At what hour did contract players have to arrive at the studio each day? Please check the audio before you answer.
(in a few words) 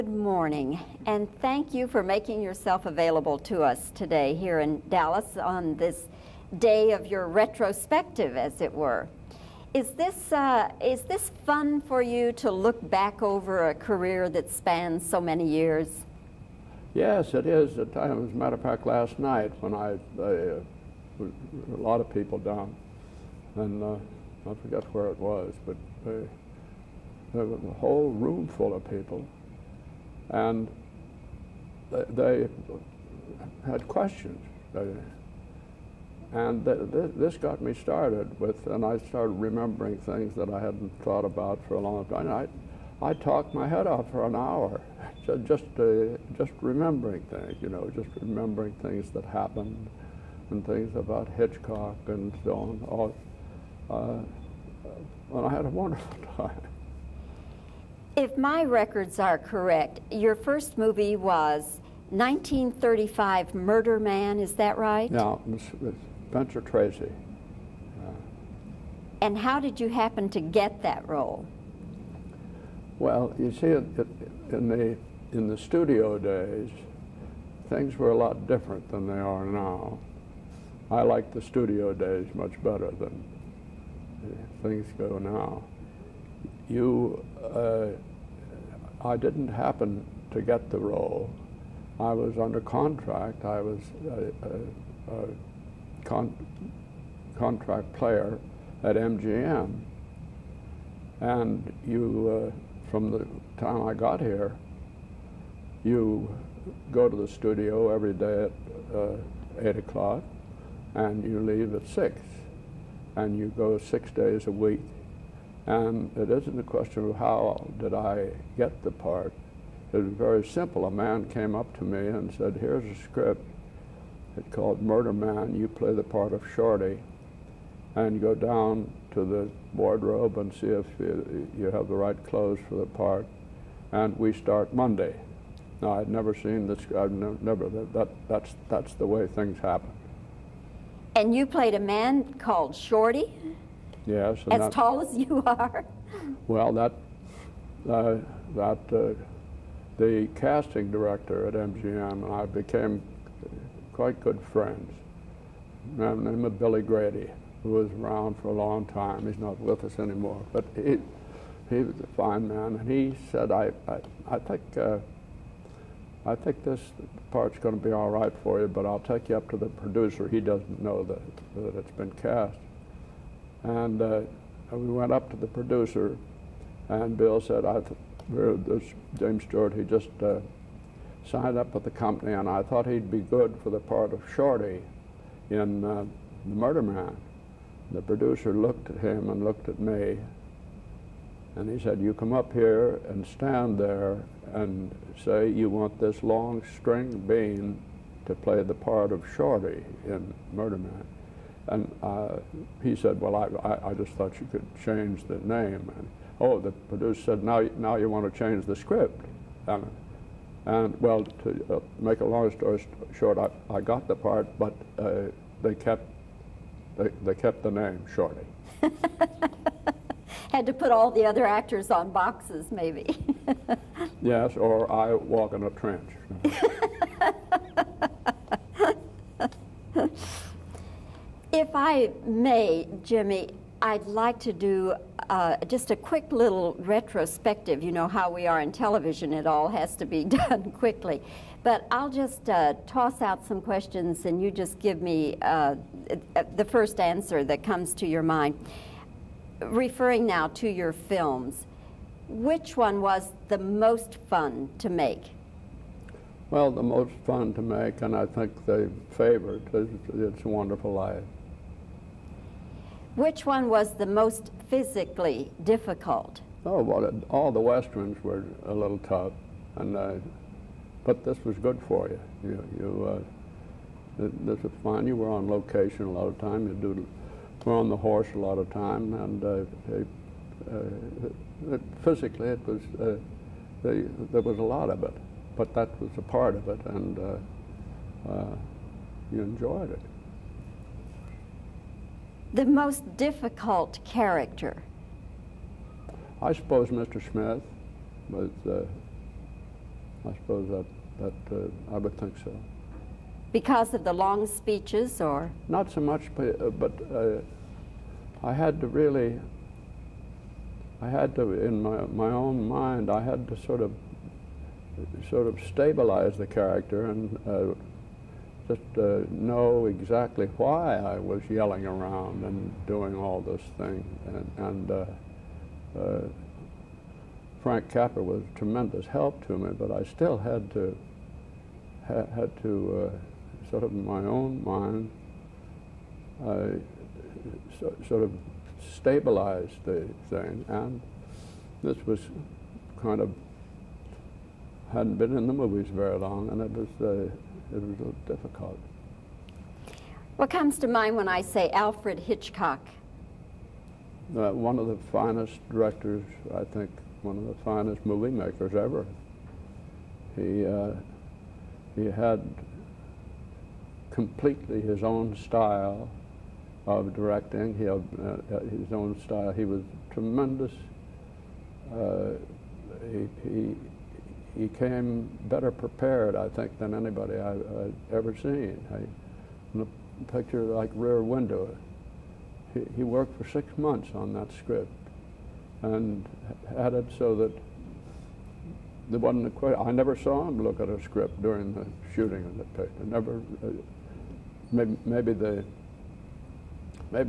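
8 o'clock.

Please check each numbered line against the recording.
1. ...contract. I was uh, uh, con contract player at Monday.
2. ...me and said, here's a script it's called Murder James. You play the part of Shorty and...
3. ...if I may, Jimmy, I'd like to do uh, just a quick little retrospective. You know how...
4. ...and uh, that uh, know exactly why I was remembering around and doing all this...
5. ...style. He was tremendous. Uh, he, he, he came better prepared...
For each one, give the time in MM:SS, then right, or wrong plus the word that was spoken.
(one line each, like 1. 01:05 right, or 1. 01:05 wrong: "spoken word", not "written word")
1. 01:32 wrong: "MGM", not "Monday"
2. 02:01 wrong: "Man", not "James"
3. 03:51 right
4. 05:17 wrong: "yelling", not "remembering"
5. 06:09 right.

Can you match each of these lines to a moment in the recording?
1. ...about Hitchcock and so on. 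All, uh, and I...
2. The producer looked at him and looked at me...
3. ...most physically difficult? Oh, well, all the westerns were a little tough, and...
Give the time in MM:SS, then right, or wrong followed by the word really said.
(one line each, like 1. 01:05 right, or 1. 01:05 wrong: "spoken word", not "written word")
1. 00:50 right
2. 03:07 right
3. 04:24 right.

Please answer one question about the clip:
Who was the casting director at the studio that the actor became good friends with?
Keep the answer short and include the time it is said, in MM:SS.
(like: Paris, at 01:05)
Billy Grady, at 02:36.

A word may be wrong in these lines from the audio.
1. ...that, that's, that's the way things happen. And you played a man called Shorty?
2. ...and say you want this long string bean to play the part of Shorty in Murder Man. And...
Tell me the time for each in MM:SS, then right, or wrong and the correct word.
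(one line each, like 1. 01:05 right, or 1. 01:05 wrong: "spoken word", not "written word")
1. 02:17 right
2. 03:14 right.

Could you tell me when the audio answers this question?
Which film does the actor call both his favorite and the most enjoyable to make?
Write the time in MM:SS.
04:20.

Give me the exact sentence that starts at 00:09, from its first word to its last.
Is this, uh, is this fun for you to look back over a career that spans so many years?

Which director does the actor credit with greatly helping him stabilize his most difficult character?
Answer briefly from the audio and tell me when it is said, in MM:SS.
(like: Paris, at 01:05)
Frank Capra, at 05:27.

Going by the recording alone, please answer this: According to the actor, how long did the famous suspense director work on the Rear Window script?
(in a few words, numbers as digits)
6 months.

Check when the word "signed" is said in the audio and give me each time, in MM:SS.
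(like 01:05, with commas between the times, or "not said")
03:01.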